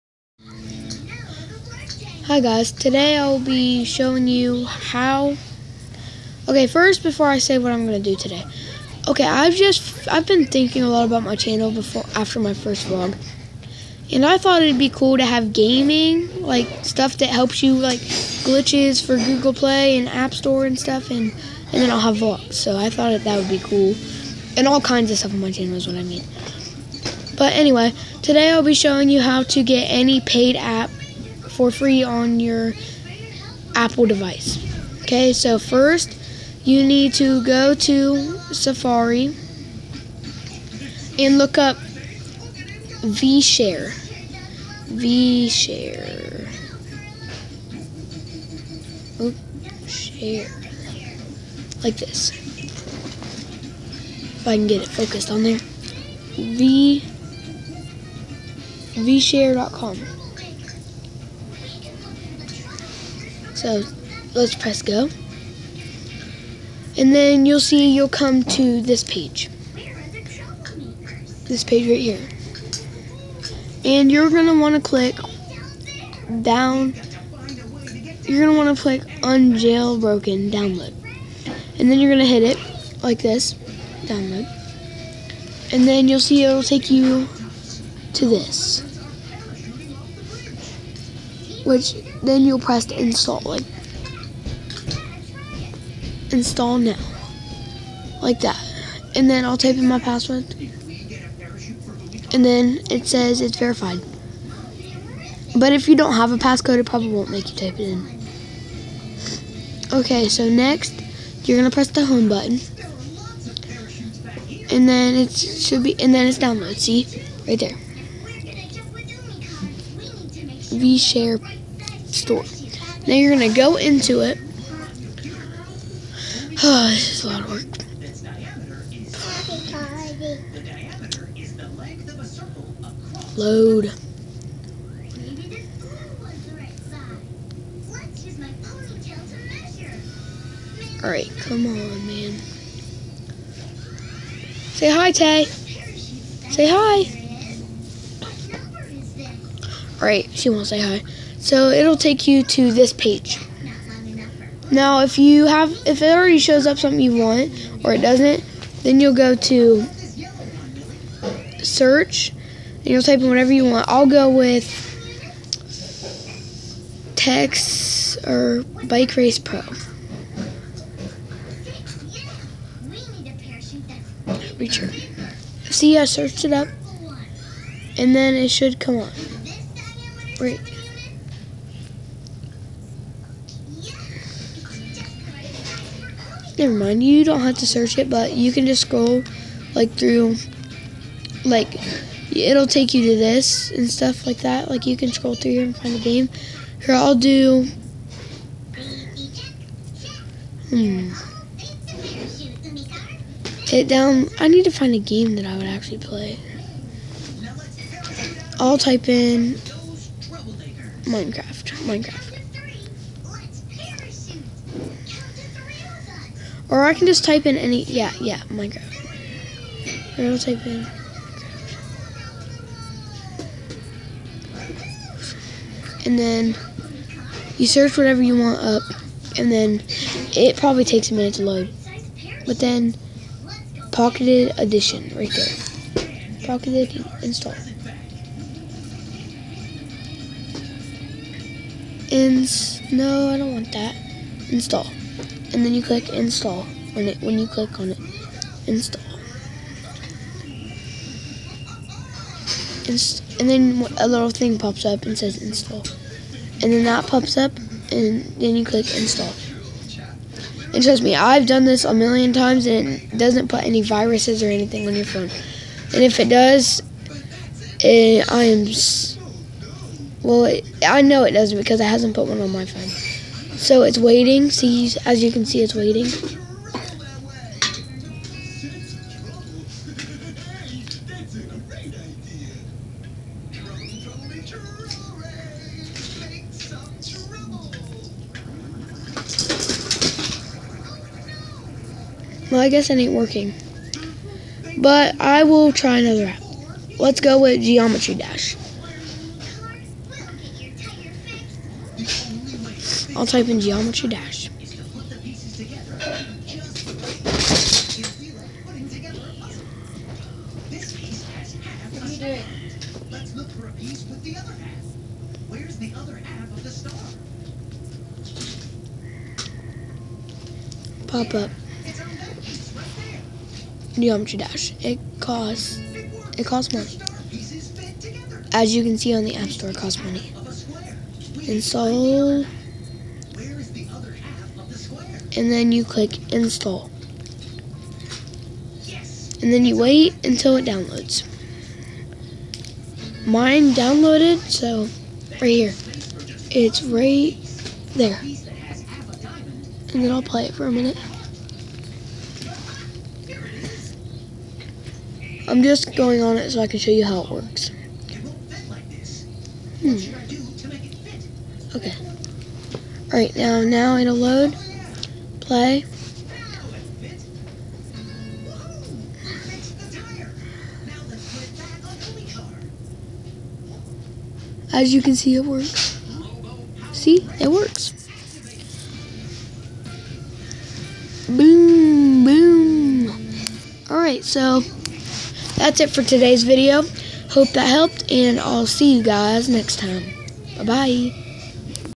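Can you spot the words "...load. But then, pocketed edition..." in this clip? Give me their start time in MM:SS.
03:51.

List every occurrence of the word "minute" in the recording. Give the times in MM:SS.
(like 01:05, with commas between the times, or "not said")
03:51, 05:50.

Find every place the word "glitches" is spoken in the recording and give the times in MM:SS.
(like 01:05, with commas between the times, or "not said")
00:18.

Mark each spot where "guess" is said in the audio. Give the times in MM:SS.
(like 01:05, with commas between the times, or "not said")
04:52.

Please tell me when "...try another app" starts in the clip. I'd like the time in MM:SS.
04:55.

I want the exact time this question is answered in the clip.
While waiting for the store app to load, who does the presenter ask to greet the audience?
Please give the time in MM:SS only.
02:25.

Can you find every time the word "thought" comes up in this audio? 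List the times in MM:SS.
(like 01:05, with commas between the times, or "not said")
00:14, 00:22.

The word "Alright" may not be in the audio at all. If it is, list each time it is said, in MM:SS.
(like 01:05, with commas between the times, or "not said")
02:21, 06:03, 06:23.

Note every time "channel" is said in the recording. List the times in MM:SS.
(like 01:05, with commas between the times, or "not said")
00:11, 00:25.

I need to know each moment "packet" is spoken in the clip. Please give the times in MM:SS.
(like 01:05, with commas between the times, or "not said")
not said.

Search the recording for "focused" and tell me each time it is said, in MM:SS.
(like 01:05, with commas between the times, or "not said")
00:54.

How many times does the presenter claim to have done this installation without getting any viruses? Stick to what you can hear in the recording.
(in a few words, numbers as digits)
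A million.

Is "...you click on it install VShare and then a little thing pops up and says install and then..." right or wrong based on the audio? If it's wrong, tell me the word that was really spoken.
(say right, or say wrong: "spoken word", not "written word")
wrong: "Inst", not "VShare".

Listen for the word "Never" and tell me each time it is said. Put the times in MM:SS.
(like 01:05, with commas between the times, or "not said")
03:06.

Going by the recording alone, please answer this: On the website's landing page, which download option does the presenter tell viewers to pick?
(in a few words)
Unjailbroken download.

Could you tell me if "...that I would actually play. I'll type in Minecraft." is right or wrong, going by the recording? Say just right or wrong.
right.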